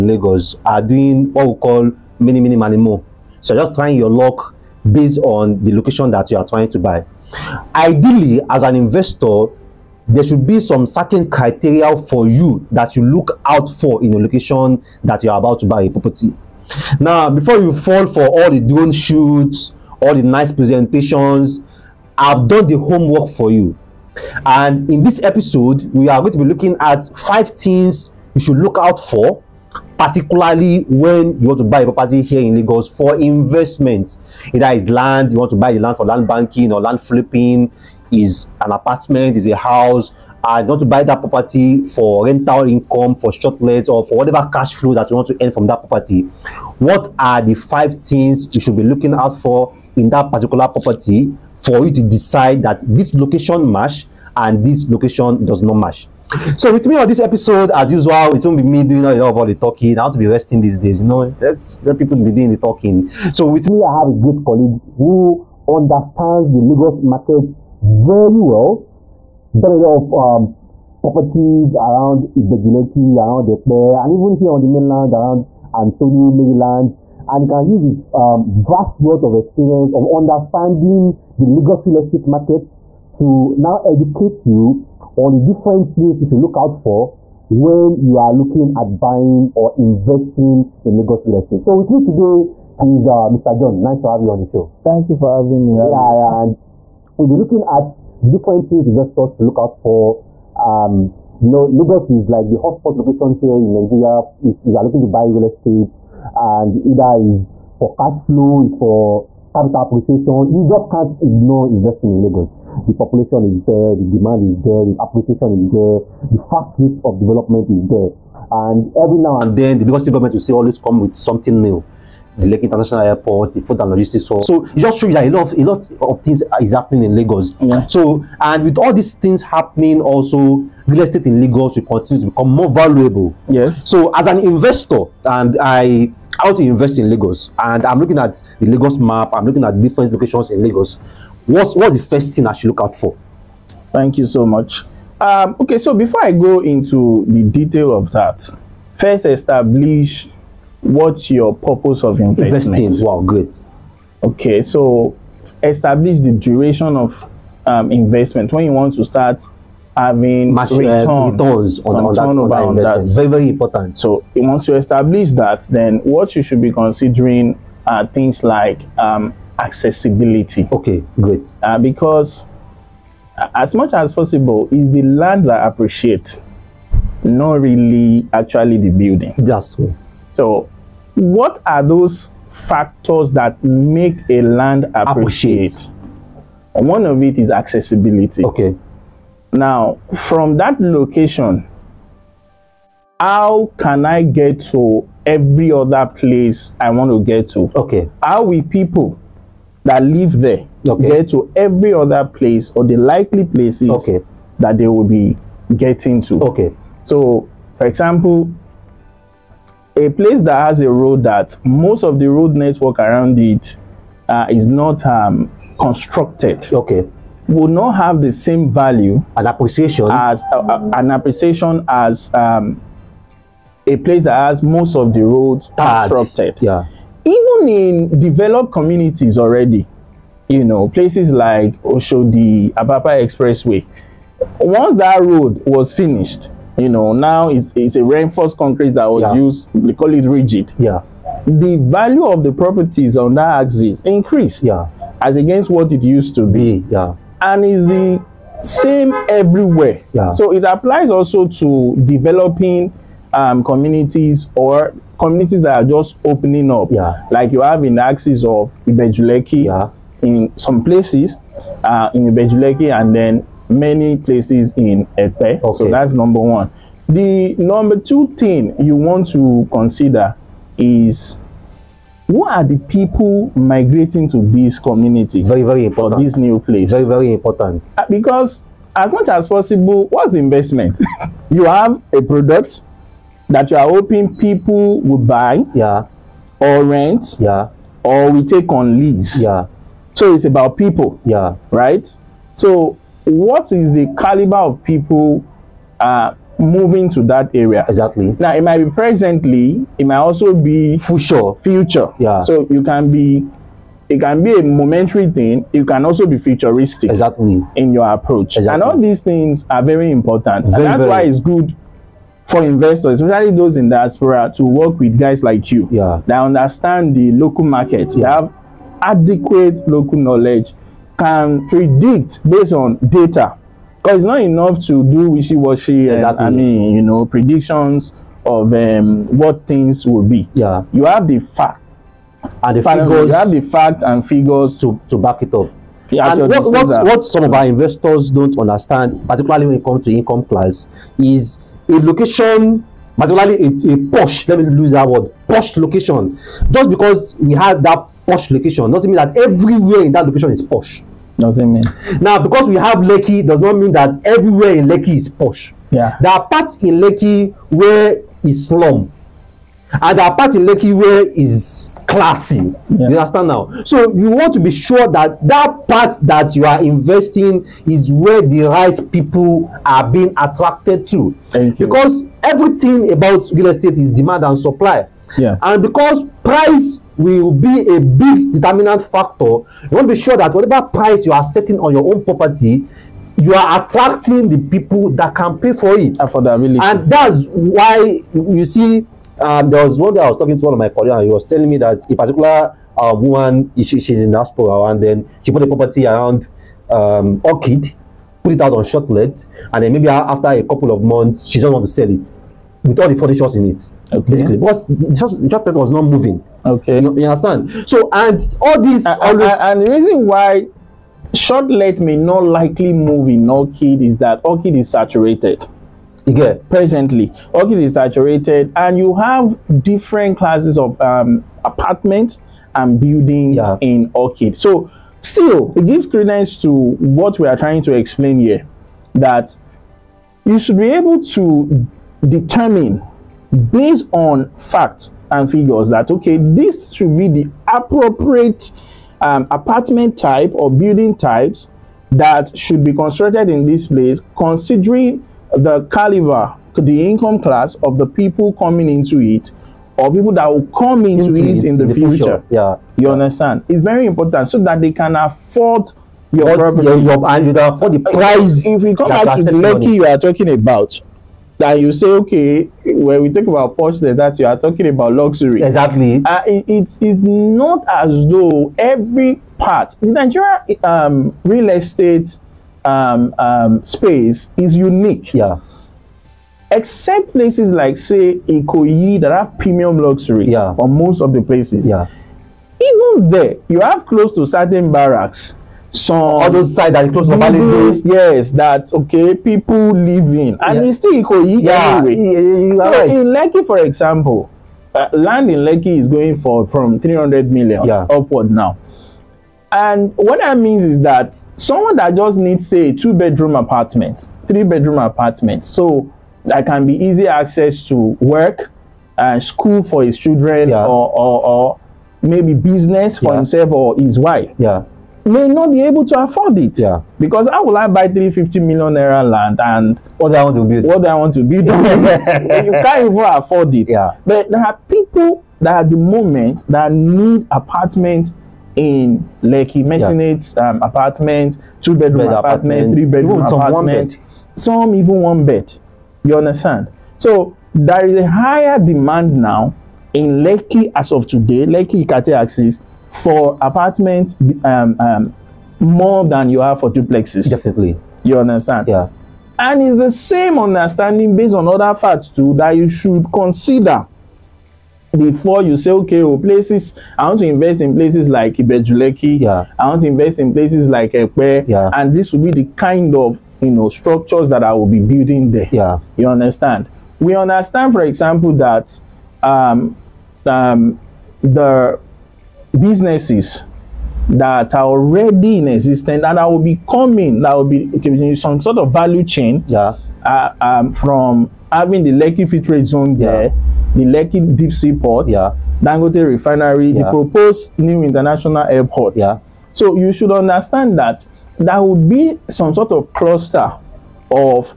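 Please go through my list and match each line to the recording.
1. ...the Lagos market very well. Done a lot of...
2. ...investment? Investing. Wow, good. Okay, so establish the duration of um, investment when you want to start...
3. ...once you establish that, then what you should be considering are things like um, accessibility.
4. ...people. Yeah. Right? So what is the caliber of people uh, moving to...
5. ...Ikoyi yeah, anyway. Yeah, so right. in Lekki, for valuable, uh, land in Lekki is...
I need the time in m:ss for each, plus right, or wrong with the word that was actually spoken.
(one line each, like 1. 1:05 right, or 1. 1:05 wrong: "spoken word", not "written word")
1. 1:06 right
2. 2:32 right
3. 2:44 right
4. 4:50 right
5. 8:11 wrong: "example", not "valuable".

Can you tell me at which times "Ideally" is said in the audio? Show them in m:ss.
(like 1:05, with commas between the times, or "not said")
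0:07.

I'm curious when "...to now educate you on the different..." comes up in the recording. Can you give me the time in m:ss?
1:23.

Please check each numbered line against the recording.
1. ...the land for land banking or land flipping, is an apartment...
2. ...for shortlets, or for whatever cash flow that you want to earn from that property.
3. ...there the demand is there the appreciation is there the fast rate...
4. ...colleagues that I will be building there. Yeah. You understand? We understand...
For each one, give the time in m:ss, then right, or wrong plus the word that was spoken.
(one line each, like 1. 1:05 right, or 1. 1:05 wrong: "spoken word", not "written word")
1. 0:35 right
2. 0:43 right
3. 1:53 right
4. 9:23 wrong: "structures", not "colleagues".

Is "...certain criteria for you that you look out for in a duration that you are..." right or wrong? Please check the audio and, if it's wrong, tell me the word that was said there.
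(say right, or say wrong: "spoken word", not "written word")
wrong: "location", not "duration".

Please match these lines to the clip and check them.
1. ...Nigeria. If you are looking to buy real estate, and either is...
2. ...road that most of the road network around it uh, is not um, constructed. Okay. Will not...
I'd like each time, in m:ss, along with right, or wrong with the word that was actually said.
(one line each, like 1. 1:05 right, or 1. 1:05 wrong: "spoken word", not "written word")
1. 1:43 right
2. 3:30 right.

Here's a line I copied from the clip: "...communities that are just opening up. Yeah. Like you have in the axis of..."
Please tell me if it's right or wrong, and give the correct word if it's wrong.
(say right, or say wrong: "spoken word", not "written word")
right.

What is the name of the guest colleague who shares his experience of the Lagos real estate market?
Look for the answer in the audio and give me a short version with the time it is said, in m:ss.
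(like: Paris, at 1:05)
Mr. John, at 1:33.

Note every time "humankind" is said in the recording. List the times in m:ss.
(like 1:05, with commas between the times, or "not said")
not said.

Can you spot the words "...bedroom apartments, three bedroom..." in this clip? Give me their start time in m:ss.
8:23.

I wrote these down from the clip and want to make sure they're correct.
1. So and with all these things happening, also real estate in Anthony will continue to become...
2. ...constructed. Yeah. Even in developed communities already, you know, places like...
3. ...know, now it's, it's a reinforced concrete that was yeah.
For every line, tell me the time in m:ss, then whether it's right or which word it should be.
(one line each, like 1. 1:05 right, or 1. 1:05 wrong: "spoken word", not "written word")
1. 2:07 wrong: "Lagos", not "Anthony"
2. 3:45 right
3. 3:56 right.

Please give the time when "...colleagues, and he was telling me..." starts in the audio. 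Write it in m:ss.
6:30.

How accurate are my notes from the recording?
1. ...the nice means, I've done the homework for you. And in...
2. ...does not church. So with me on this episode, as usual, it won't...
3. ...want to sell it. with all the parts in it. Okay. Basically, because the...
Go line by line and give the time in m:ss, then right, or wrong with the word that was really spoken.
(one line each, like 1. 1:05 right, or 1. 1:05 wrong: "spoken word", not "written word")
1. 0:20 wrong: "presentations", not "means"
2. 0:55 wrong: "match", not "church"
3. 6:41 wrong: "shots", not "parts".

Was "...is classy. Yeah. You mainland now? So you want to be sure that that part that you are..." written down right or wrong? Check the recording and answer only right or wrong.
wrong.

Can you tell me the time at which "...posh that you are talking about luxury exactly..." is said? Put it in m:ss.
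7:43.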